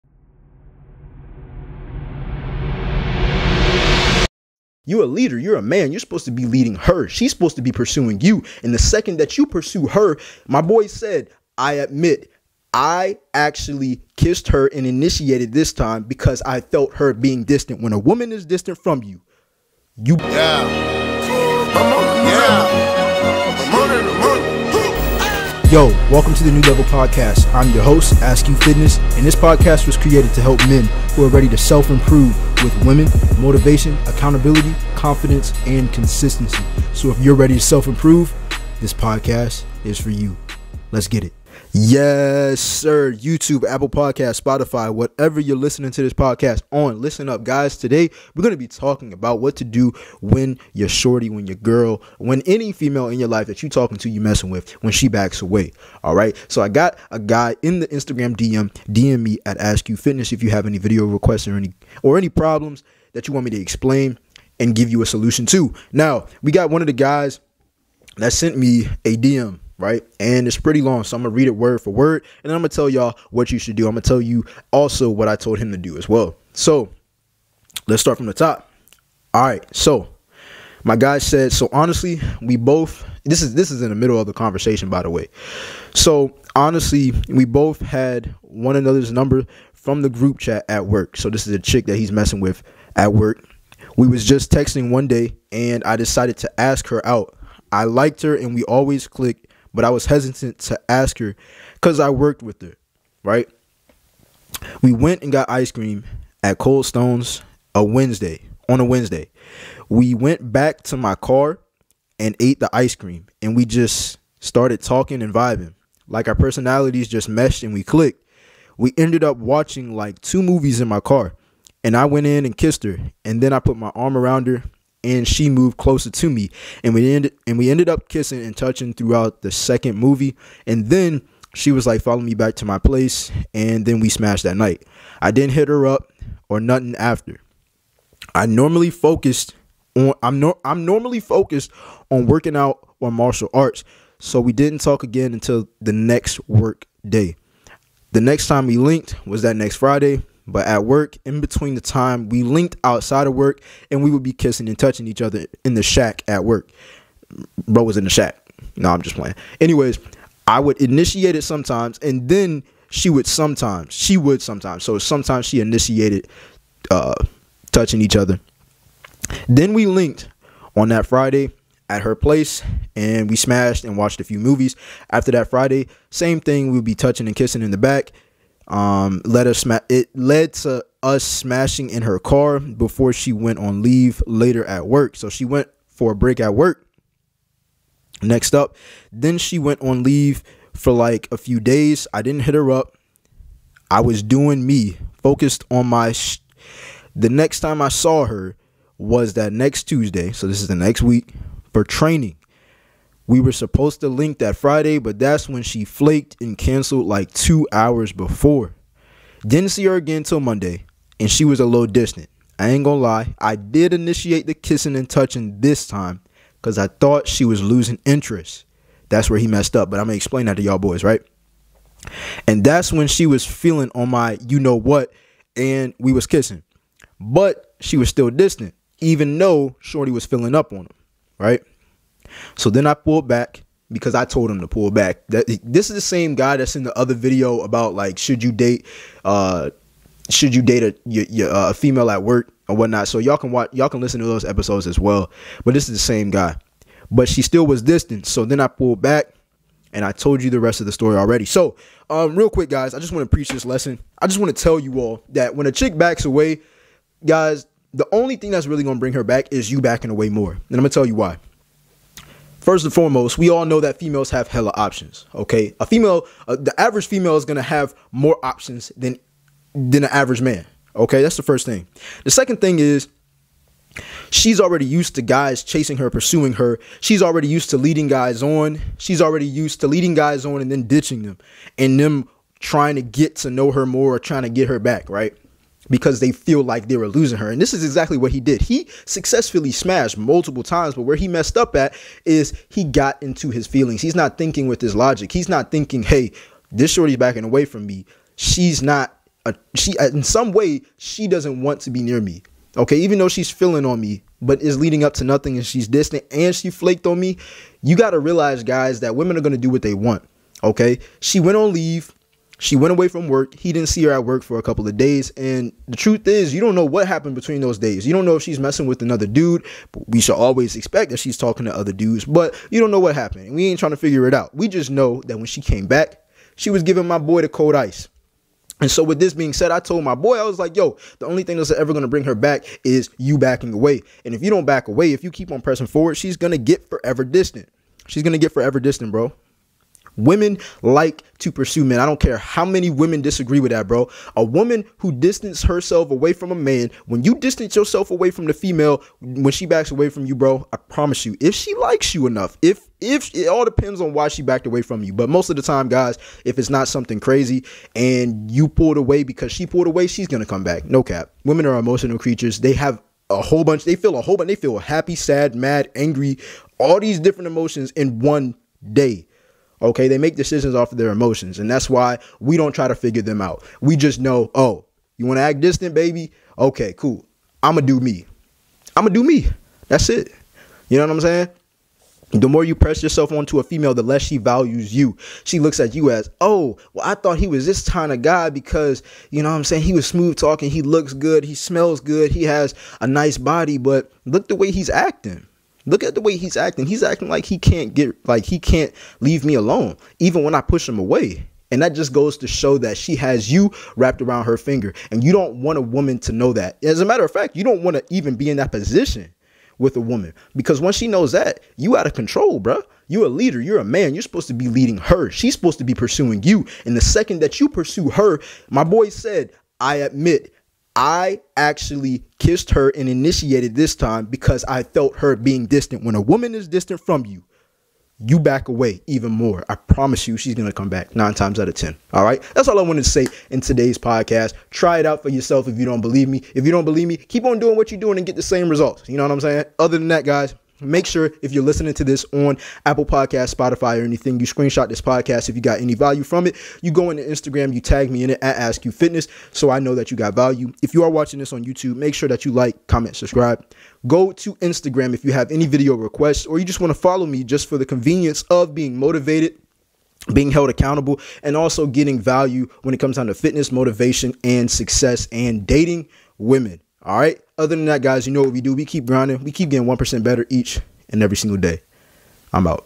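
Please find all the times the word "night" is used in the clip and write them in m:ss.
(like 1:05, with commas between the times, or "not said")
2:14.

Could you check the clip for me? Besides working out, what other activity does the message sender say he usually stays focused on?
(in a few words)
martial arts.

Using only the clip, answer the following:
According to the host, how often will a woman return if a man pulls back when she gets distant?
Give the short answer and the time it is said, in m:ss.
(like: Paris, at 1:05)
9 out of 10, at 7:11.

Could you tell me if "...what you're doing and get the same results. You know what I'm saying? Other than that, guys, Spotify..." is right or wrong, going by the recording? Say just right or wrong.
wrong.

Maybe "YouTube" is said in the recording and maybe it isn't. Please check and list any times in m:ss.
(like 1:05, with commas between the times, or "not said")
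0:43, 7:31.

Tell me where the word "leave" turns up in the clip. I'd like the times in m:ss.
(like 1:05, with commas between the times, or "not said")
3:03, 3:10, 5:11, 6:39.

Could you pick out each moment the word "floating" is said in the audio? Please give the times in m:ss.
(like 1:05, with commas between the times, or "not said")
not said.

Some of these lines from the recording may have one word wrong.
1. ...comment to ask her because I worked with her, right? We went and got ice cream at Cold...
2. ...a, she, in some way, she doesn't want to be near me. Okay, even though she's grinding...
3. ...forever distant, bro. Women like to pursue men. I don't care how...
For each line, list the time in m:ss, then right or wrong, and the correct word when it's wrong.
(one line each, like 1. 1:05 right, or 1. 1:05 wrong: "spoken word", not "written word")
1. 1:40 wrong: "hesitant", not "comment"
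2. 4:59 wrong: "feeling", not "grinding"
3. 5:38 right.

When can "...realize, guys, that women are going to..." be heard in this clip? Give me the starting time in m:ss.
5:08.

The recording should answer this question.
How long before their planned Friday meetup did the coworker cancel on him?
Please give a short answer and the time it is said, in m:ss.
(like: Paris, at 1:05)
2 hours, at 3:27.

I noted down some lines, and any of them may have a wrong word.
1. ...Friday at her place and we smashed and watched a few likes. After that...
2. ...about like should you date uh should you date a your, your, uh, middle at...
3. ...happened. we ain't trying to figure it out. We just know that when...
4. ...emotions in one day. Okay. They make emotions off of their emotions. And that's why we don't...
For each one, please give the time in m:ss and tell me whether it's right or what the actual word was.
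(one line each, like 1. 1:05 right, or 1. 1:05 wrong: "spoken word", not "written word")
1. 2:51 wrong: "movies", not "likes"
2. 3:57 wrong: "female", not "middle"
3. 5:23 right
4. 6:07 wrong: "decisions", not "emotions".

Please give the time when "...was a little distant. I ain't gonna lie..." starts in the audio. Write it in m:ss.
3:31.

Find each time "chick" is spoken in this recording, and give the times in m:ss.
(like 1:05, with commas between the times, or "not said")
1:31, 4:15.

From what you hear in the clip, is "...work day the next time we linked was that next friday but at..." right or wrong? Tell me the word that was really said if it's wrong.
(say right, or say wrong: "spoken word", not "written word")
right.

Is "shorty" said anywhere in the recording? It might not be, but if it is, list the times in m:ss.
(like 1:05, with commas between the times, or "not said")
0:50, 3:49, 4:56.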